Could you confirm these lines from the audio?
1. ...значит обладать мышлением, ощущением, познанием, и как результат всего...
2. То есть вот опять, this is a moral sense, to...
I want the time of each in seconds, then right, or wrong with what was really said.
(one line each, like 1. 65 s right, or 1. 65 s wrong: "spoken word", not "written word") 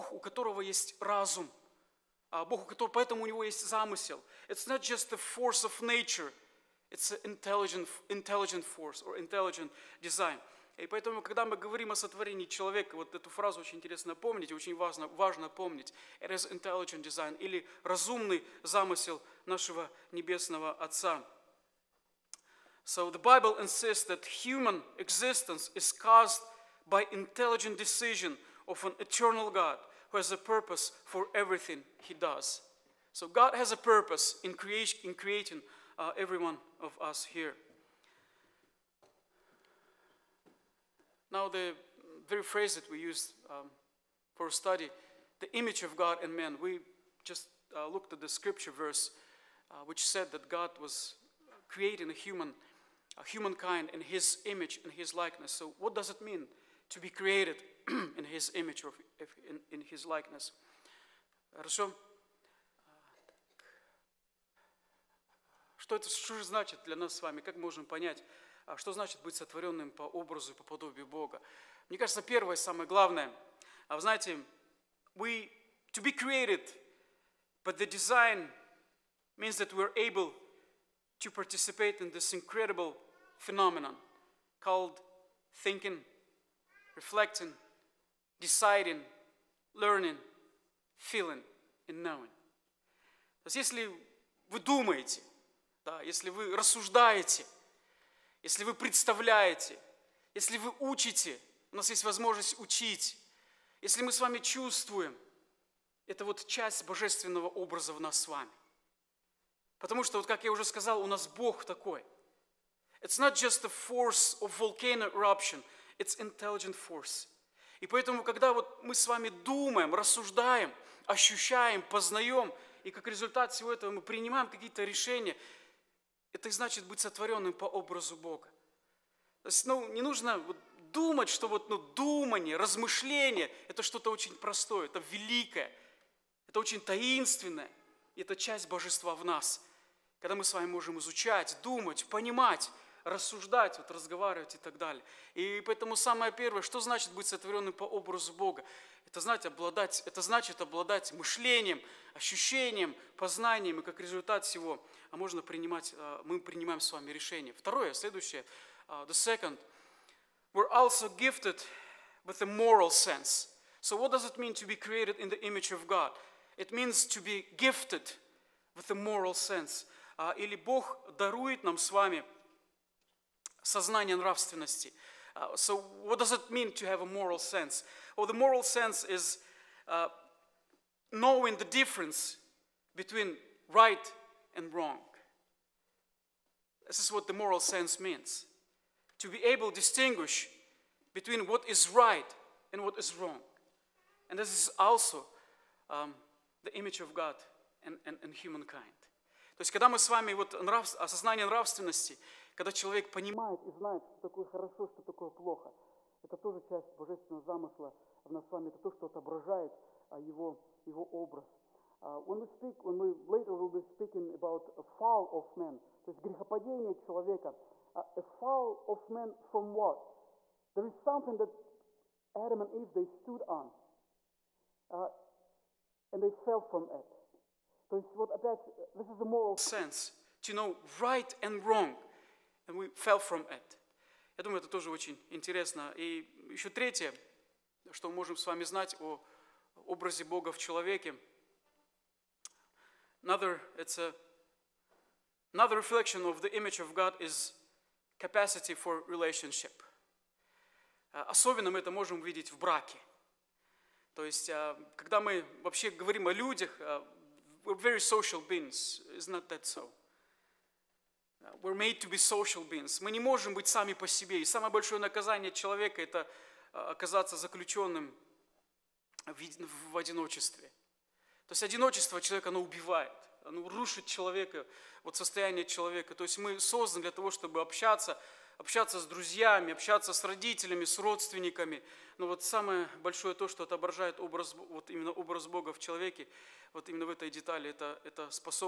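1. 150 s right
2. 227 s right.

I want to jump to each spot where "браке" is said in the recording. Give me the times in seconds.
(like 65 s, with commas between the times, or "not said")
252 s.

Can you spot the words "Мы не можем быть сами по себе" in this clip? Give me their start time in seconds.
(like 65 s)
263 s.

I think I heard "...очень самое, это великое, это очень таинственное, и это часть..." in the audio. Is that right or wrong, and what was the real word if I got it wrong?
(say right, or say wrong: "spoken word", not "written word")
wrong: "простое", not "самое".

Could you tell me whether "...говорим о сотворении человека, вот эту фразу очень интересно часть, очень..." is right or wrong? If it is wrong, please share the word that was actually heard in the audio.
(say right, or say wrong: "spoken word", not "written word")
wrong: "помнить", not "часть".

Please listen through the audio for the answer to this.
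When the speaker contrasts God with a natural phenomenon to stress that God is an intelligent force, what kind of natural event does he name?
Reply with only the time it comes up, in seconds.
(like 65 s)
114 s.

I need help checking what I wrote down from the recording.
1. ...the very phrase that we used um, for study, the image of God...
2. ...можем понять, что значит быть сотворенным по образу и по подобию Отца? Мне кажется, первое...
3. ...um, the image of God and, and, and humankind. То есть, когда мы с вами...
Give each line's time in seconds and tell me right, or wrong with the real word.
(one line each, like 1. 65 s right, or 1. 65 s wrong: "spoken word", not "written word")
1. 41 s right
2. 67 s wrong: "Бога", not "Отца"
3. 195 s right.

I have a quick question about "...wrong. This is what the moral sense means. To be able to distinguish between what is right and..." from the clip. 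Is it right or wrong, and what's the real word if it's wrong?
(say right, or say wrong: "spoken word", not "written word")
right.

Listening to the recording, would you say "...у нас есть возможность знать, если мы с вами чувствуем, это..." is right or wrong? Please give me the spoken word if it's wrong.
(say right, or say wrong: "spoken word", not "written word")
wrong: "учить", not "знать".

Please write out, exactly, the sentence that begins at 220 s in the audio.
There is something that Adam and Eve, they stood on.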